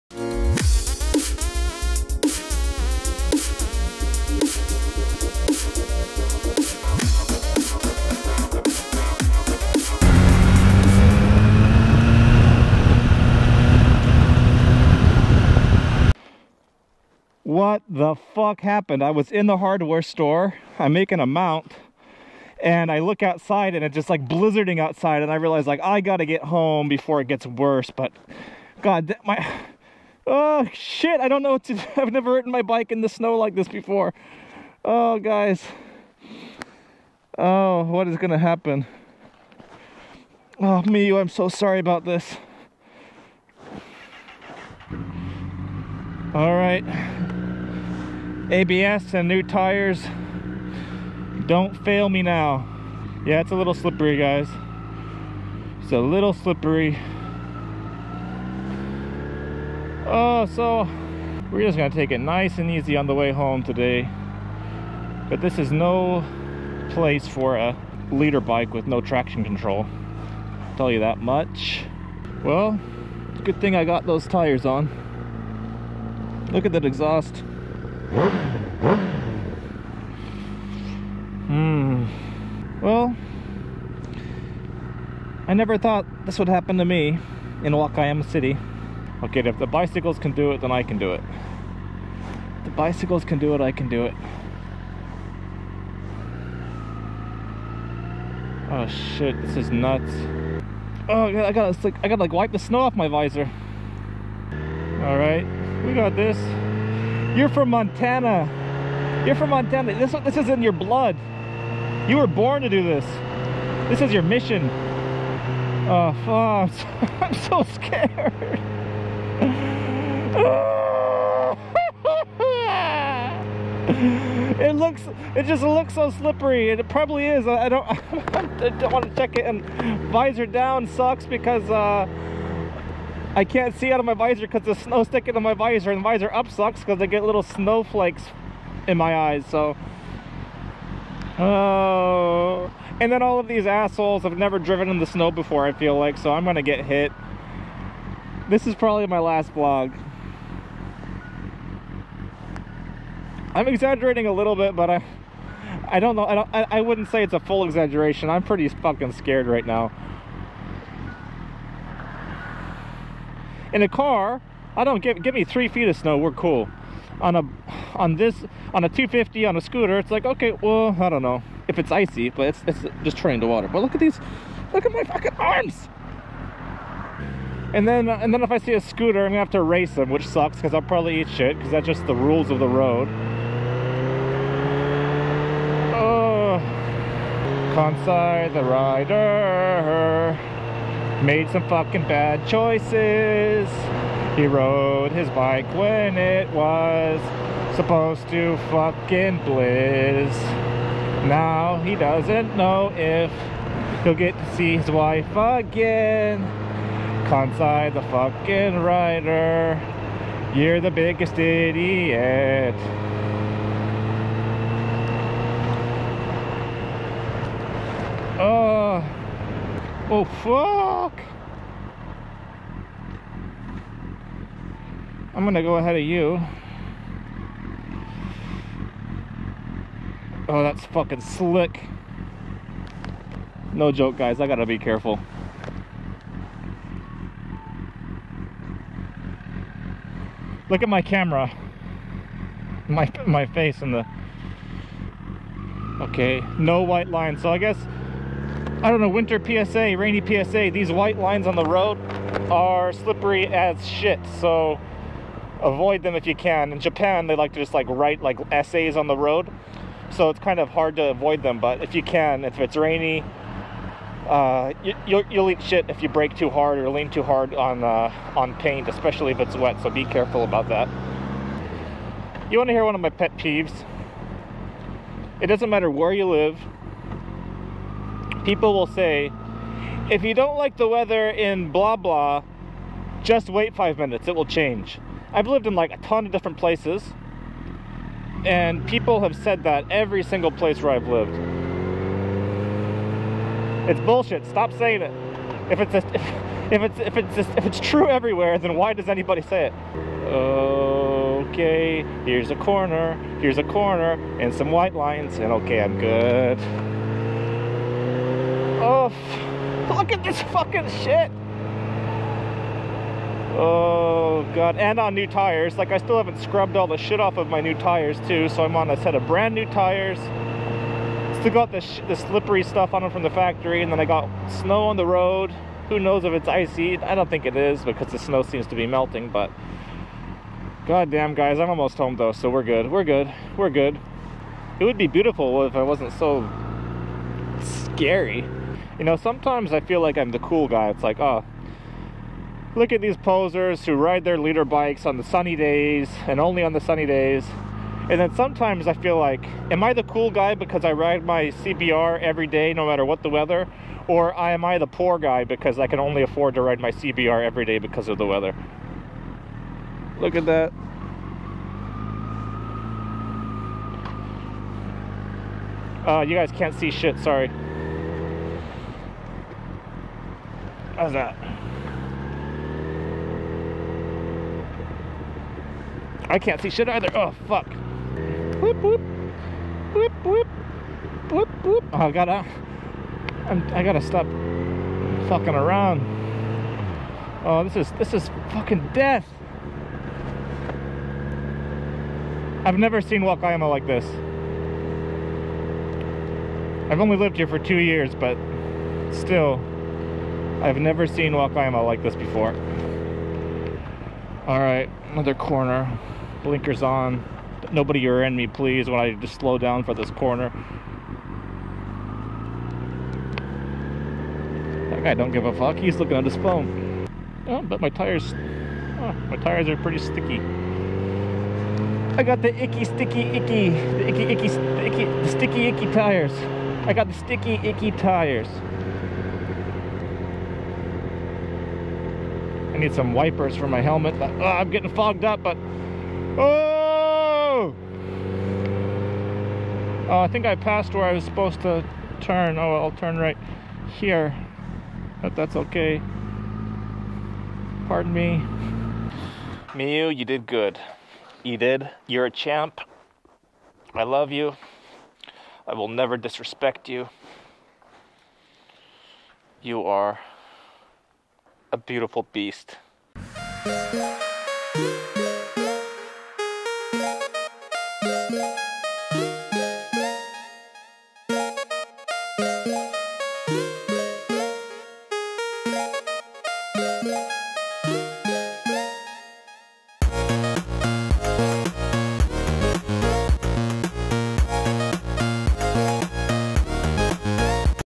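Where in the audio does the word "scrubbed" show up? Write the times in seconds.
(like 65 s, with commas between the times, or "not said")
316 s.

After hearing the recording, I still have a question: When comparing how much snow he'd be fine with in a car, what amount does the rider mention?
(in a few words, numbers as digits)
three feet.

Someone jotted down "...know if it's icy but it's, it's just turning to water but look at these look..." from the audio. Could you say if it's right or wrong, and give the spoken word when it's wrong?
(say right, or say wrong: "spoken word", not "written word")
right.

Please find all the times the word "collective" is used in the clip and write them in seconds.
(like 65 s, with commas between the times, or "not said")
not said.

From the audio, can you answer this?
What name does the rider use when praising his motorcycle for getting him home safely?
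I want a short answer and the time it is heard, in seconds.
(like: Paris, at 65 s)
Miu, at 449 s.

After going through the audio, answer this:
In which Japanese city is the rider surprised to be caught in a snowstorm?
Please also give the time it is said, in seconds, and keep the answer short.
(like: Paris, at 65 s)
Wakayama City, at 87 s.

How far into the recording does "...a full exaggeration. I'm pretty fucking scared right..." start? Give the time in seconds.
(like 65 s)
157 s.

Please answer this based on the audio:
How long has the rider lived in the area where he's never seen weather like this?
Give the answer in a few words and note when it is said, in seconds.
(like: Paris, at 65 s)
2 years, at 397 s.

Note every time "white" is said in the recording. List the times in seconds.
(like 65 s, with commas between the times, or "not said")
246 s, 250 s, 304 s.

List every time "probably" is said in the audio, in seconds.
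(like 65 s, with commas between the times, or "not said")
126 s, 148 s, 180 s.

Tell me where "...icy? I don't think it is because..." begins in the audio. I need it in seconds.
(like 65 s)
326 s.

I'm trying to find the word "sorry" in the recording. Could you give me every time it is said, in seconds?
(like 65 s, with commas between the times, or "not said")
41 s, 367 s.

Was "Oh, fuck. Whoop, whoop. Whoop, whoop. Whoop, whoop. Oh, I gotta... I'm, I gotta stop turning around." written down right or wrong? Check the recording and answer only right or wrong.
wrong.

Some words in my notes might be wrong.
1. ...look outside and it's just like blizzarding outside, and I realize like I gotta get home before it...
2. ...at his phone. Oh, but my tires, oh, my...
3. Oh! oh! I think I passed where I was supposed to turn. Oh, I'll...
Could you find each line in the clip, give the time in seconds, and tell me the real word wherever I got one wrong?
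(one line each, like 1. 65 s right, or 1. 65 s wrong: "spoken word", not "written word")
1. 22 s right
2. 416 s right
3. 436 s right.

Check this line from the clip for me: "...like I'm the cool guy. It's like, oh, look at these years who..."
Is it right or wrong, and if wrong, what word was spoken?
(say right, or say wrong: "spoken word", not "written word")
wrong: "posers", not "years".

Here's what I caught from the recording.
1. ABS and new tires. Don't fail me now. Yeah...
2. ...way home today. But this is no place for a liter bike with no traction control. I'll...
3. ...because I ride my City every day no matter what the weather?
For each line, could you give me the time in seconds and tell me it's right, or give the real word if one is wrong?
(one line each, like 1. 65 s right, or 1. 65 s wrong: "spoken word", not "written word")
1. 48 s right
2. 63 s right
3. 350 s wrong: "CBR", not "City".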